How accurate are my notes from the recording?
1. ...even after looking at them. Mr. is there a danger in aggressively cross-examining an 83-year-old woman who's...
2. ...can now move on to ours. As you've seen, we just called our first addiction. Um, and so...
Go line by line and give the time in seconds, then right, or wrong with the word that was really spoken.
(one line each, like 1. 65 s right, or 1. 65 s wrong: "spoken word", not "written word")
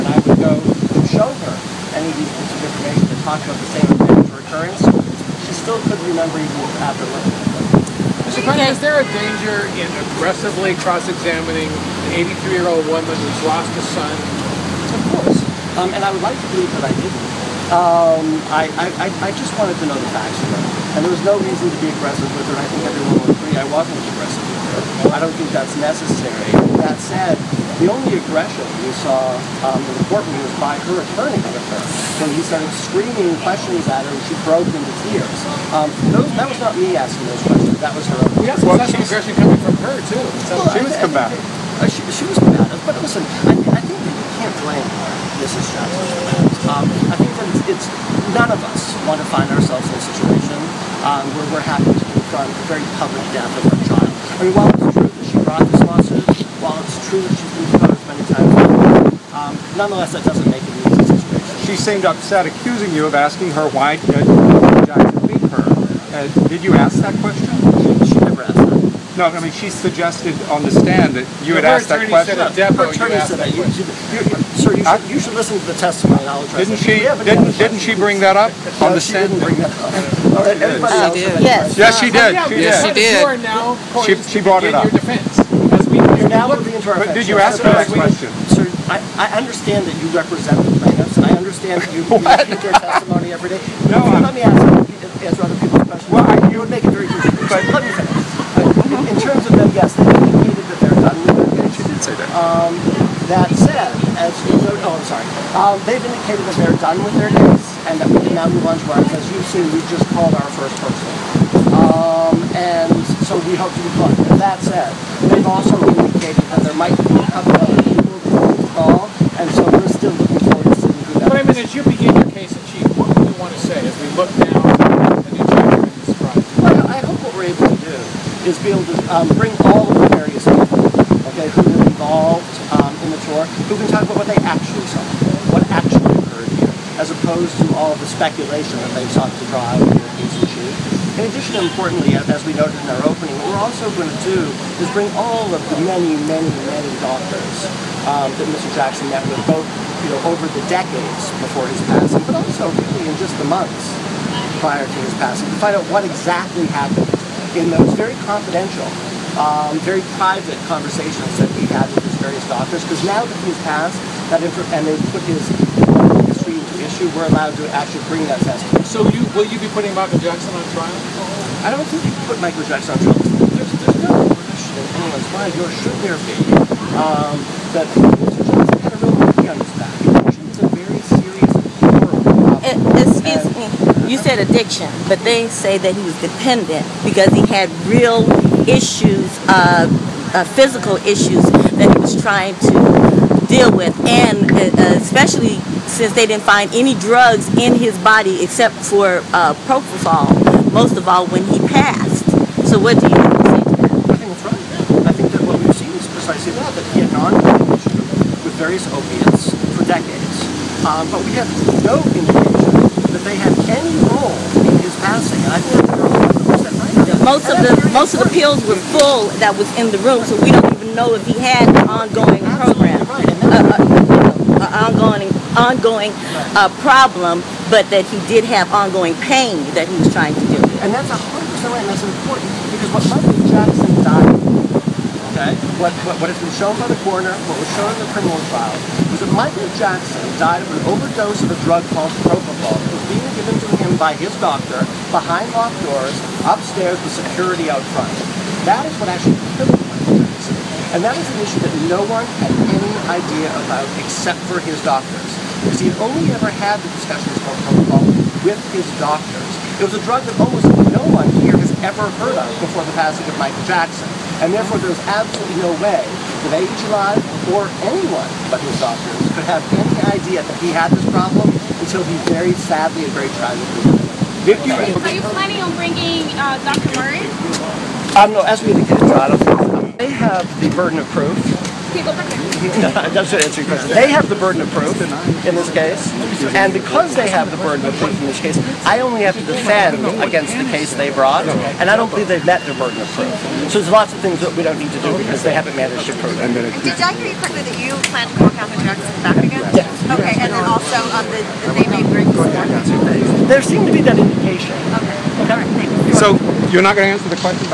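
1. 6 s right
2. 108 s wrong: "person", not "addiction".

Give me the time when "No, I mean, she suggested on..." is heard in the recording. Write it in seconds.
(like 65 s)
69 s.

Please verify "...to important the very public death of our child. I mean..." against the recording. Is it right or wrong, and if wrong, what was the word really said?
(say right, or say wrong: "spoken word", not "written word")
wrong: "confront", not "important".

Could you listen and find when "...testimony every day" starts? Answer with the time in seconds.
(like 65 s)
92 s.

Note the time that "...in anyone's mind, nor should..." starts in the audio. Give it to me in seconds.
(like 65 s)
174 s.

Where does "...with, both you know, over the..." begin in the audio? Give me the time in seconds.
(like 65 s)
149 s.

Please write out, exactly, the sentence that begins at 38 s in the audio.
We also well, saw some aggression coming from her, too.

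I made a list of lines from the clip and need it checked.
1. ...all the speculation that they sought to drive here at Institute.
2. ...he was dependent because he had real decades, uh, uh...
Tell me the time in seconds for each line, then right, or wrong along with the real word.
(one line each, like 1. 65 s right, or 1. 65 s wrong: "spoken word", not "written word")
1. 137 s right
2. 185 s wrong: "issues", not "decades".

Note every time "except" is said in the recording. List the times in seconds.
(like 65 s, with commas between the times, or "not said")
198 s, 254 s.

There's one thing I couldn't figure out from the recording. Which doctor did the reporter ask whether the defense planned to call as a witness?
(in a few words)
Dr. Murray.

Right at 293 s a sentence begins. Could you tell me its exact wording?
So there's lots of things that we don't need to do because they haven't managed to prove it.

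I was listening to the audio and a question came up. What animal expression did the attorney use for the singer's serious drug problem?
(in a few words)
monkey on his back.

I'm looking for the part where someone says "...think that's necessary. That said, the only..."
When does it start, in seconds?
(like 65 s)
25 s.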